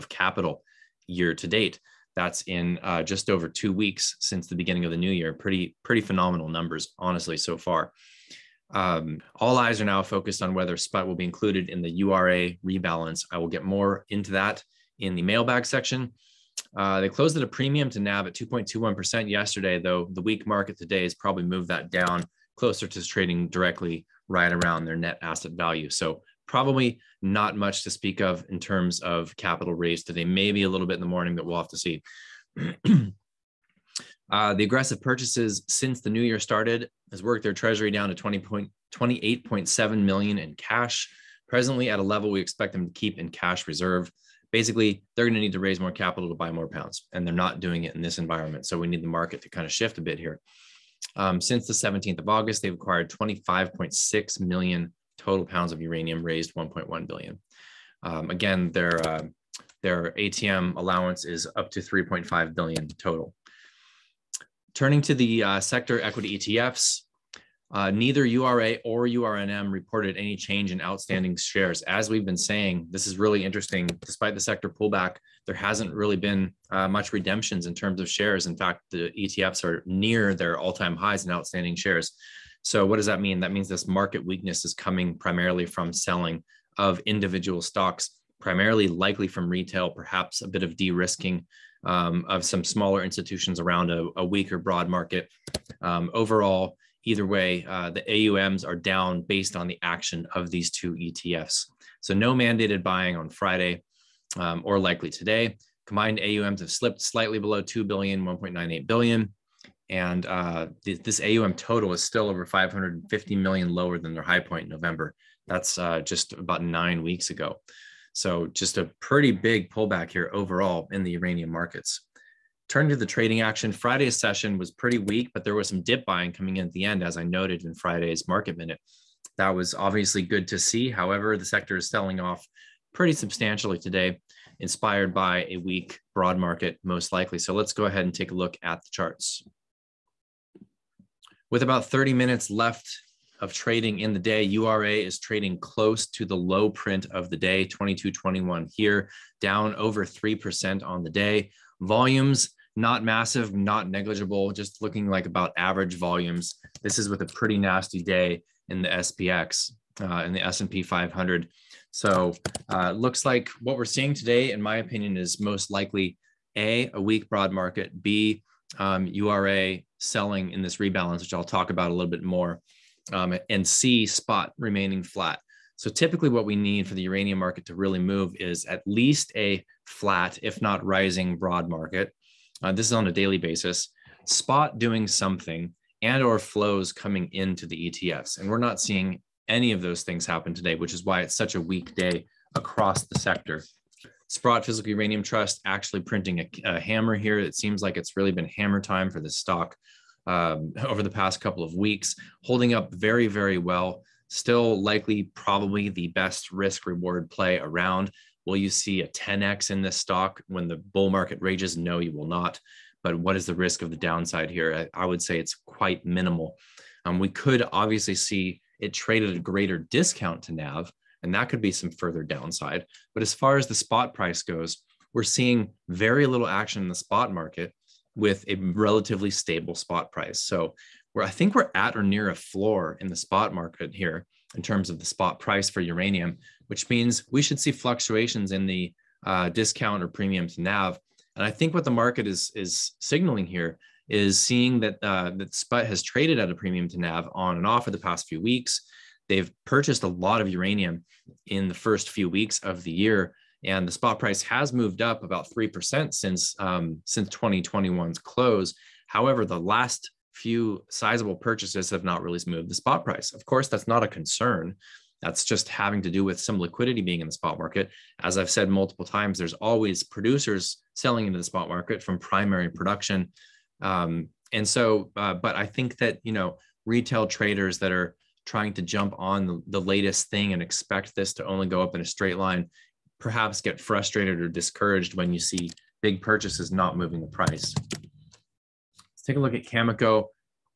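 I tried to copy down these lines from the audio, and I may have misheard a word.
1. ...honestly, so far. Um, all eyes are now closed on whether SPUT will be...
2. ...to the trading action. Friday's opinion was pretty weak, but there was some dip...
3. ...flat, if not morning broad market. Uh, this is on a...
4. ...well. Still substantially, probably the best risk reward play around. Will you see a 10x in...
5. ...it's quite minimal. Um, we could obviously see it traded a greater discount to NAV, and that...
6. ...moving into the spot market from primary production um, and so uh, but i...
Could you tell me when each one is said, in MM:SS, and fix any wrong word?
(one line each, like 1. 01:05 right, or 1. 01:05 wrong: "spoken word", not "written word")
1. 00:06 wrong: "focused", not "closed"
2. 02:02 wrong: "session", not "opinion"
3. 02:59 wrong: "rising", not "morning"
4. 03:23 wrong: "likely", not "substantially"
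5. 03:35 right
6. 04:30 wrong: "selling", not "moving".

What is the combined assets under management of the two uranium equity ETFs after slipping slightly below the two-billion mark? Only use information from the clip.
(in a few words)
1.98 billion.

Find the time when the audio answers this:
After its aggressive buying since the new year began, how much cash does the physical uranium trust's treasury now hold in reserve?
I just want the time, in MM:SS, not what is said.
00:38.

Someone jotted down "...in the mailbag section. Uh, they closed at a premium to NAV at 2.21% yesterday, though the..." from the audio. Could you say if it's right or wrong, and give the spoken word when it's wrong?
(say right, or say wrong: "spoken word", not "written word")
right.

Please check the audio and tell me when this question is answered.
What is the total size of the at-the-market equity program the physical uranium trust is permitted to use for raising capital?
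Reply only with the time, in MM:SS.
01:01.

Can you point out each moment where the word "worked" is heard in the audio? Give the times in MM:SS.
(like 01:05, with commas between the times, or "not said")
00:37.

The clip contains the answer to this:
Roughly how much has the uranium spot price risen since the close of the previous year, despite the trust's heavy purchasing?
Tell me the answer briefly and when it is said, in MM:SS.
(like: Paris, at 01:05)
about 3%, at 04:15.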